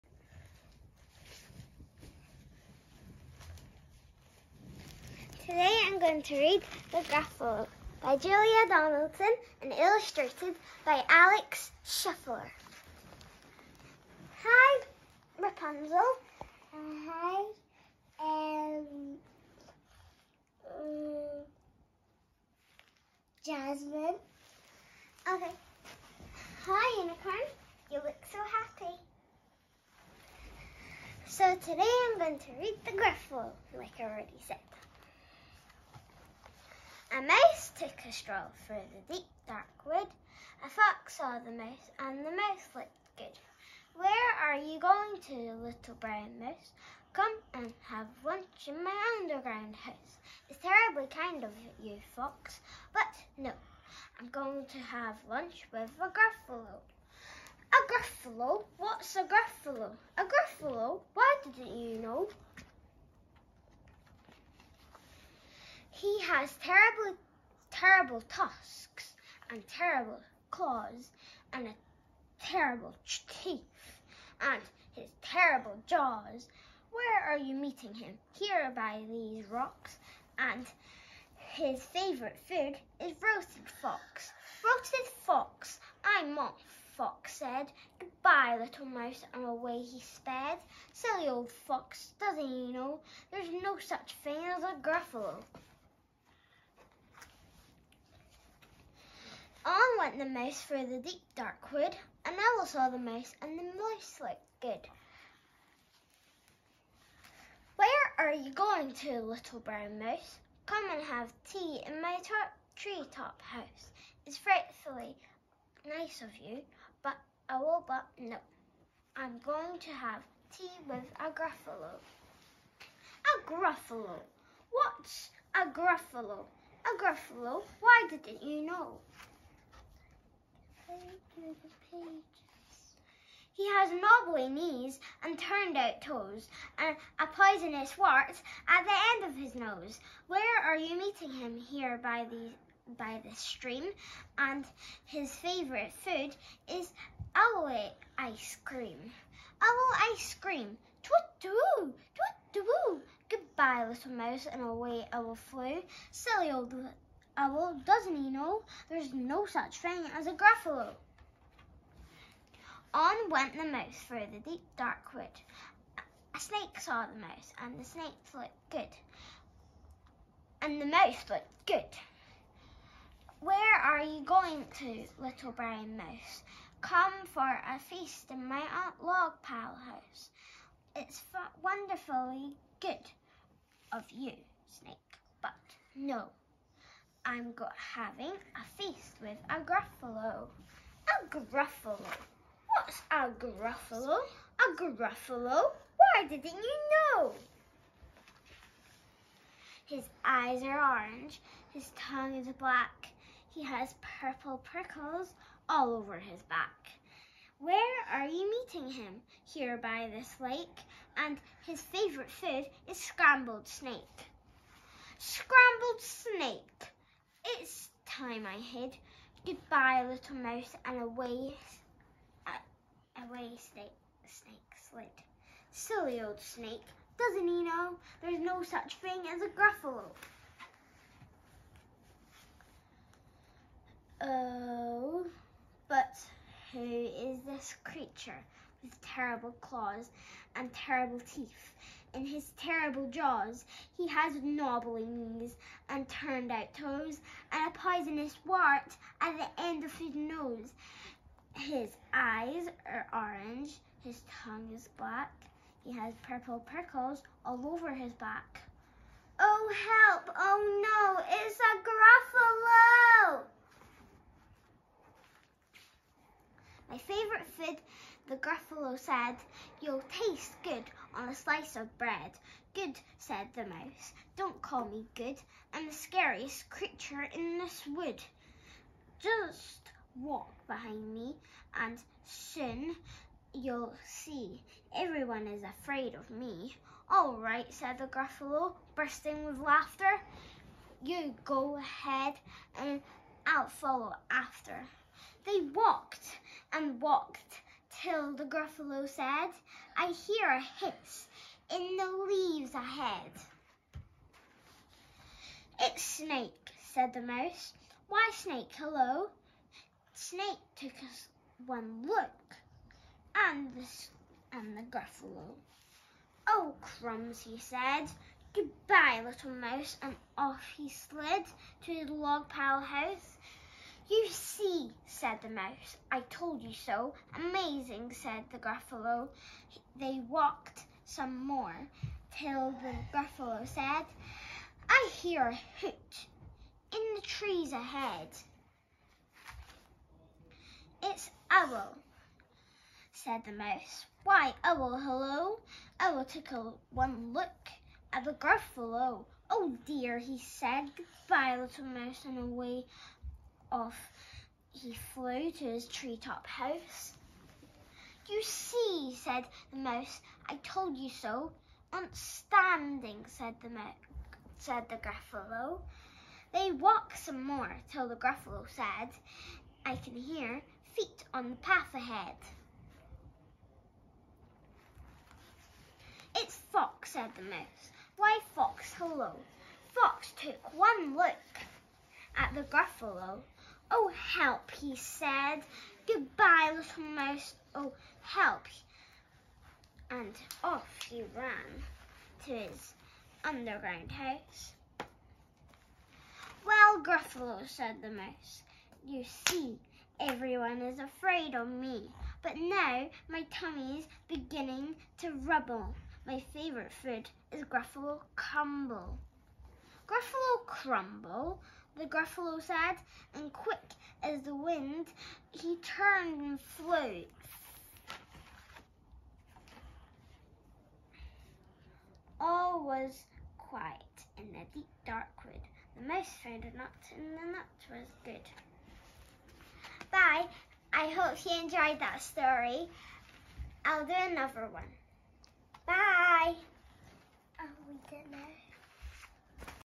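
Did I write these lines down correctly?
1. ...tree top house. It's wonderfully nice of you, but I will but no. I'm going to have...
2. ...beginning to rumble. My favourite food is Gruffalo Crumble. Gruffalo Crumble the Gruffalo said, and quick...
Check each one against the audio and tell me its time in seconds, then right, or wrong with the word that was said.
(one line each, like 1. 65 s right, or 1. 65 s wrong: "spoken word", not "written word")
1. 112 s wrong: "frightfully", not "wonderfully"
2. 404 s right.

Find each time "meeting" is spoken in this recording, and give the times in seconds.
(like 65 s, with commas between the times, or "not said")
77 s, 140 s, 208 s.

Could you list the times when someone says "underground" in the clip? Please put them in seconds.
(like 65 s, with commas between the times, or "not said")
49 s, 393 s.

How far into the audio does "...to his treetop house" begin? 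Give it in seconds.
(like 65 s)
355 s.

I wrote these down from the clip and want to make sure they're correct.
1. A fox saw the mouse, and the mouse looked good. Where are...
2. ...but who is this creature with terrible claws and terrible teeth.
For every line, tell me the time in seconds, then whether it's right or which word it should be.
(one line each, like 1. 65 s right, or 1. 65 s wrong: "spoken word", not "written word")
1. 40 s right
2. 235 s right.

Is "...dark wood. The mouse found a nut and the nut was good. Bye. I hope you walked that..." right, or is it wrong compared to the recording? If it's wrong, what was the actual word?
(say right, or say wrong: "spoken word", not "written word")
wrong: "enjoyed", not "walked".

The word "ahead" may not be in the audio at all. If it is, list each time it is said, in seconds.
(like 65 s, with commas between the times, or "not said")
291 s, 302 s, 337 s, 371 s.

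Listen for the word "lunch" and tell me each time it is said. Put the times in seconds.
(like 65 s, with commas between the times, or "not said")
48 s, 55 s.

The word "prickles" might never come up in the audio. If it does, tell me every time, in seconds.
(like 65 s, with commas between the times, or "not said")
204 s, 256 s.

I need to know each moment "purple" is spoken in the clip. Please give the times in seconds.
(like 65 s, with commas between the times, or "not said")
204 s, 256 s.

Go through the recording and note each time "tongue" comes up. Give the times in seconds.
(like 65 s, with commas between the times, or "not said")
201 s, 254 s.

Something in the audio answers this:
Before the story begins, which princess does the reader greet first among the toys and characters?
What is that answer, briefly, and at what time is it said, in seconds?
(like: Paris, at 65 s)
Rapunzel, at 15 s.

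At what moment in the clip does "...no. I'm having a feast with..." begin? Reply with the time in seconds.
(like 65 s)
185 s.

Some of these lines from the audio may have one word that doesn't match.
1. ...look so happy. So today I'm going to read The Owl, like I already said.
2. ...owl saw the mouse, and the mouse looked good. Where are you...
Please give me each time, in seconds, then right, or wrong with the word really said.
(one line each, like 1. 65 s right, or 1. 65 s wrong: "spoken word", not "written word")
1. 27 s wrong: "Gruffalo", not "Owl"
2. 102 s right.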